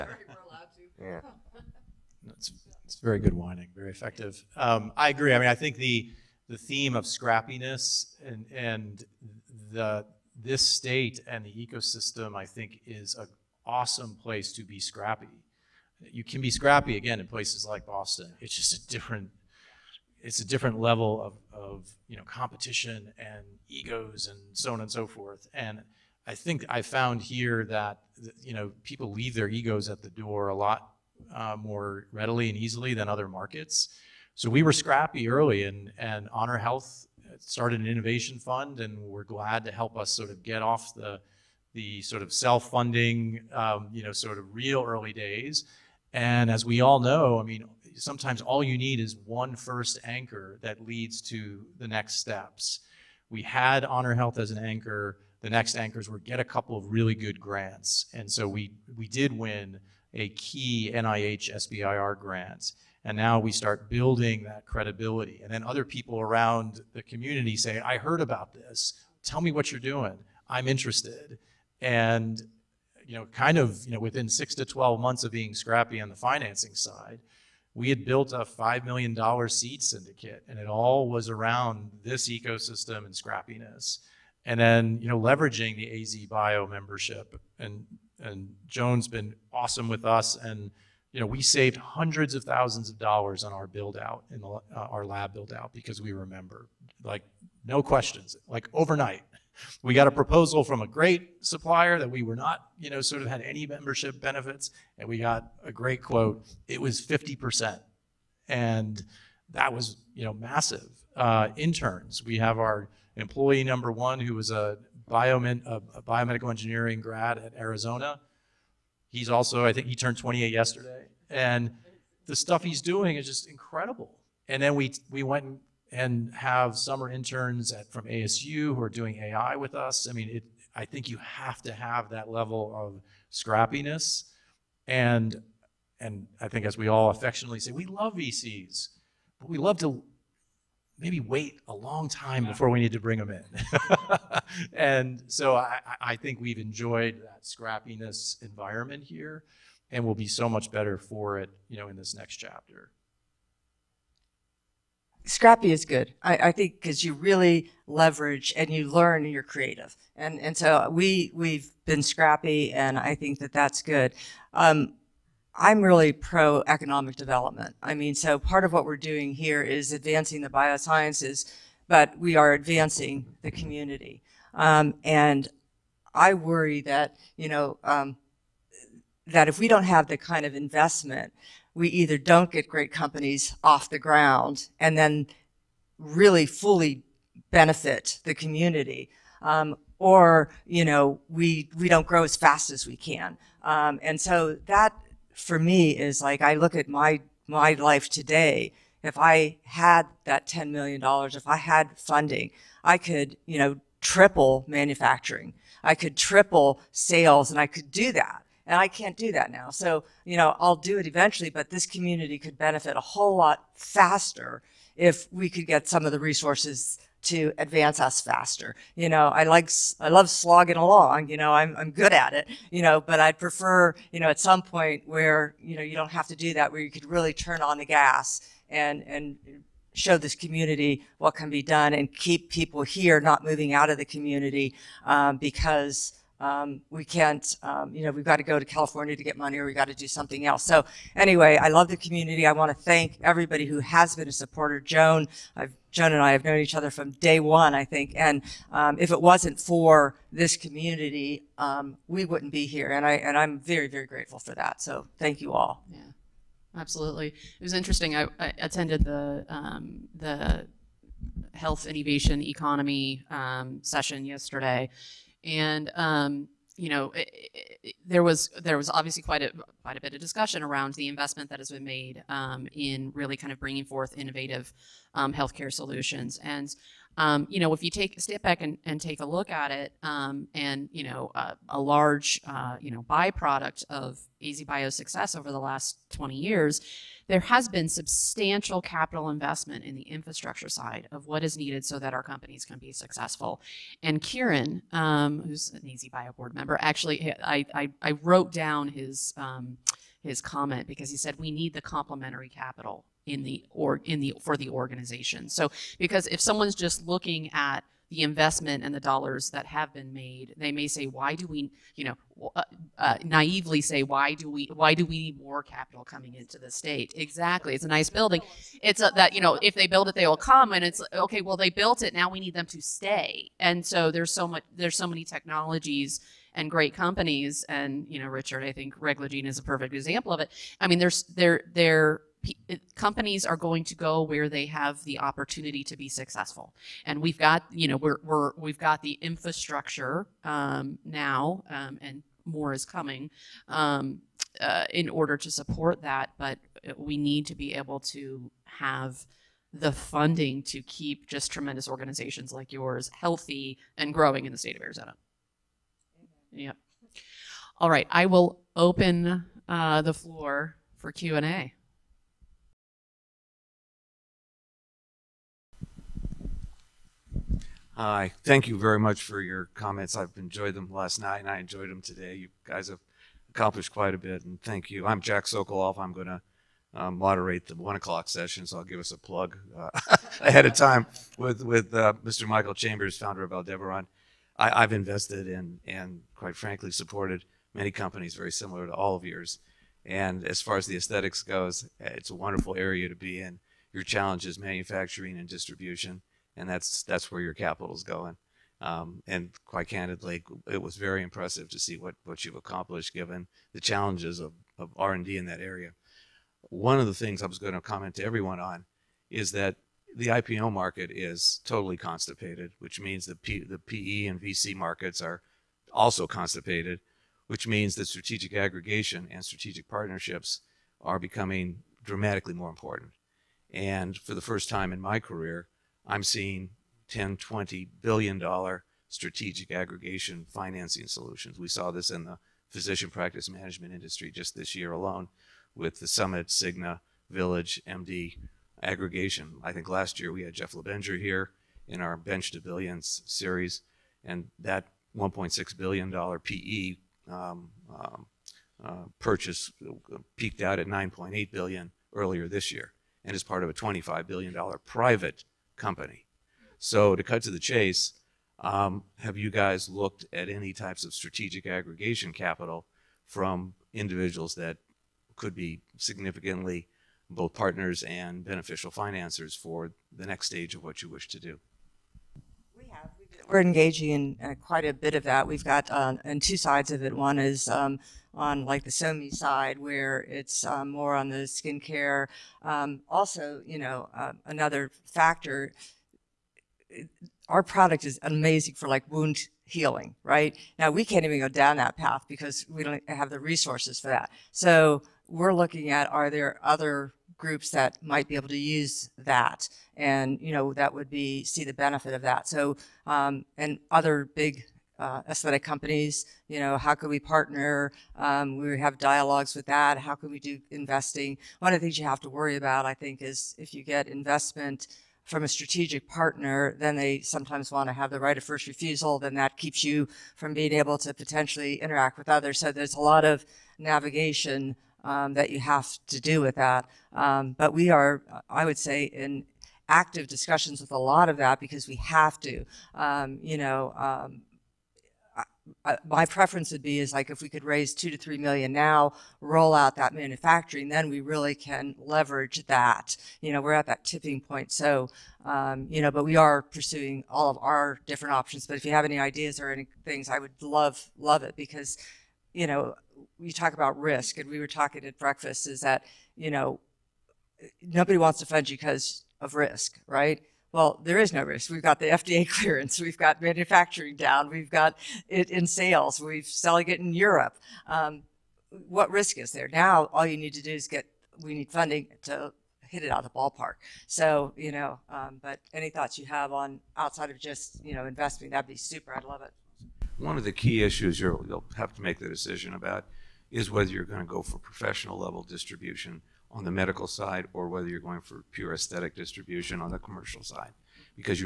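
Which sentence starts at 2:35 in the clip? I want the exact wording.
Scrappy is good, I, I think, because you really leverage and you learn and you're creative.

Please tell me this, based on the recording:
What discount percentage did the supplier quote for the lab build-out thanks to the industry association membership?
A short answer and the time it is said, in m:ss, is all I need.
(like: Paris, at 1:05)
50%, at 1:47.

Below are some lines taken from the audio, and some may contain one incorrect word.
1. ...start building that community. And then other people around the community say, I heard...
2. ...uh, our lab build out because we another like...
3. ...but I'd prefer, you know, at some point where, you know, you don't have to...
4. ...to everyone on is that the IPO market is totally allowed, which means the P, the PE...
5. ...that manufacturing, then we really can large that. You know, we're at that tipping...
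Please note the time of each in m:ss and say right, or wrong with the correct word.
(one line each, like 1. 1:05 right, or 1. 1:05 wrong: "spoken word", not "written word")
1. 1:03 wrong: "credibility", not "community"
2. 1:34 wrong: "remember", not "another"
3. 3:42 right
4. 6:48 wrong: "constipated", not "allowed"
5. 8:59 wrong: "leverage", not "large".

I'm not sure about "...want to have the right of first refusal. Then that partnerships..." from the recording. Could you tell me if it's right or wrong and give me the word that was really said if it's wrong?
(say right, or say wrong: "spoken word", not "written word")
wrong: "keeps", not "partnerships".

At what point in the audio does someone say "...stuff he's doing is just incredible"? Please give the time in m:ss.
2:02.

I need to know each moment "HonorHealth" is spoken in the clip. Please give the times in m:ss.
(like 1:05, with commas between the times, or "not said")
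0:36, 0:53.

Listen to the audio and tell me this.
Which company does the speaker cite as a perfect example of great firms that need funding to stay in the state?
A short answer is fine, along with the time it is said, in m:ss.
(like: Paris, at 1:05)
Reglagene, at 5:28.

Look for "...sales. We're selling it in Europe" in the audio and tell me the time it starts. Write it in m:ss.
9:25.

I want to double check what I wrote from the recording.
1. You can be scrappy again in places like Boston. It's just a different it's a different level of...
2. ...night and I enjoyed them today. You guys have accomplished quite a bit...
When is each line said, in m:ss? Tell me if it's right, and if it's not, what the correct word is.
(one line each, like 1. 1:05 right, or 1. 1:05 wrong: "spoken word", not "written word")
1. 0:16 right
2. 6:11 right.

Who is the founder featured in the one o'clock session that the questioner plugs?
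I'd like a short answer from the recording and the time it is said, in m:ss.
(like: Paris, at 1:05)
Michael Chambers, at 6:22.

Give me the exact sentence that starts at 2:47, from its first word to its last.
I mean, so part of what we're doing here is advancing the biosciences, but we are advancing the community.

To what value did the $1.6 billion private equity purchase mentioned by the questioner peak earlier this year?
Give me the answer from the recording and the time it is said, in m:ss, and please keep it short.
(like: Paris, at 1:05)
9.8 billion, at 7:30.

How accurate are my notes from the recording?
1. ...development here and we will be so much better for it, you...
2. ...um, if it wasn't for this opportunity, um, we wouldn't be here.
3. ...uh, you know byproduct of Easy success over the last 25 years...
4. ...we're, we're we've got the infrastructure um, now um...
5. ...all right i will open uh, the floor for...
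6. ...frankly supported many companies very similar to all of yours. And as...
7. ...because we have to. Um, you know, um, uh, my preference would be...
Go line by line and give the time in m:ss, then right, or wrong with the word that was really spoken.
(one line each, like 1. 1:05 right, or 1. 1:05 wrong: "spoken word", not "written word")
1. 2:28 wrong: "environment", not "development"
2. 4:08 wrong: "community", not "opportunity"
3. 4:42 wrong: "20", not "25"
4. 5:37 right
5. 5:57 right
6. 6:26 right
7. 8:51 right.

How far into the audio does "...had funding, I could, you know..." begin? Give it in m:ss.
3:21.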